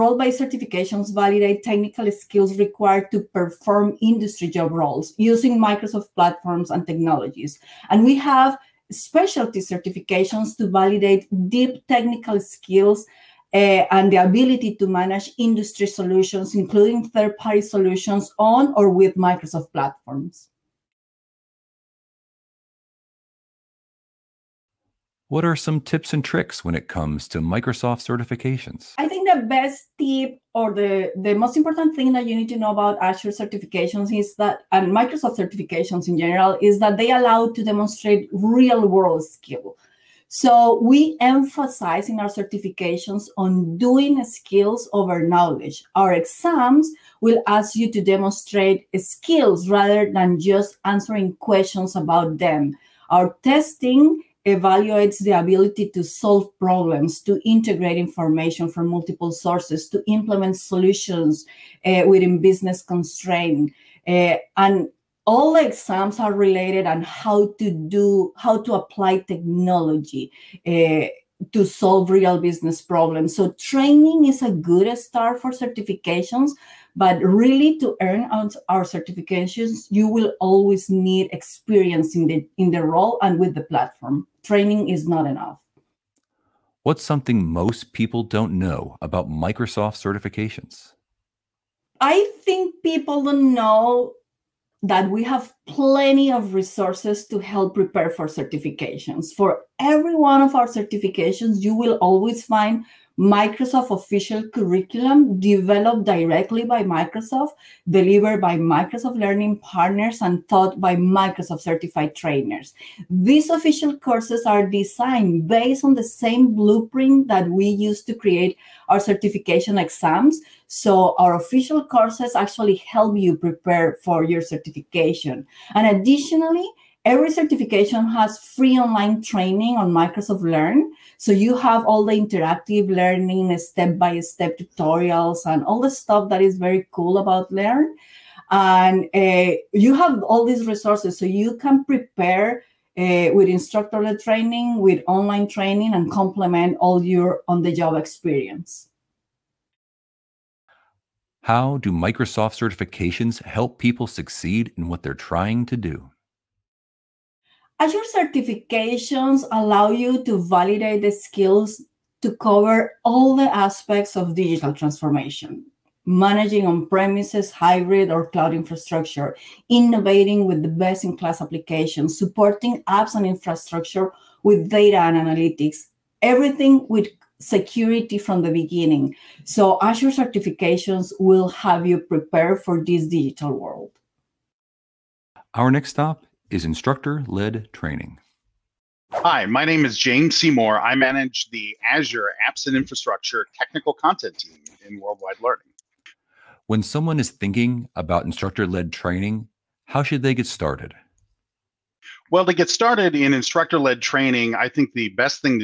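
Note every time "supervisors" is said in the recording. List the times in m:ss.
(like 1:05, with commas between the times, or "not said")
not said.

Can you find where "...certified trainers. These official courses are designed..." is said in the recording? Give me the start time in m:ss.
1:51.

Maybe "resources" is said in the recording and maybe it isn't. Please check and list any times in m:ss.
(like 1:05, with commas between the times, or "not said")
1:36, 2:20.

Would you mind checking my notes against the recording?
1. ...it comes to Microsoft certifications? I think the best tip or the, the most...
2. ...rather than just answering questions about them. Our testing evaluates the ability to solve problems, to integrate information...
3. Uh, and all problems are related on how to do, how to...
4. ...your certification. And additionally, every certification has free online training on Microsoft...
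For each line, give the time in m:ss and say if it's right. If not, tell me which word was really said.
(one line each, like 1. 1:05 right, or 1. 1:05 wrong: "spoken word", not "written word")
1. 0:26 right
2. 0:49 right
3. 1:04 wrong: "exams", not "problems"
4. 2:04 right.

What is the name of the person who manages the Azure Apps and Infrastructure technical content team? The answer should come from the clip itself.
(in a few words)
James Seymour.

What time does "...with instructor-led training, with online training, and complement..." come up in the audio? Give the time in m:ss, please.
2:23.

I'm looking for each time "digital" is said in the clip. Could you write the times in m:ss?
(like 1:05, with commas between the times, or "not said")
2:44, 3:03.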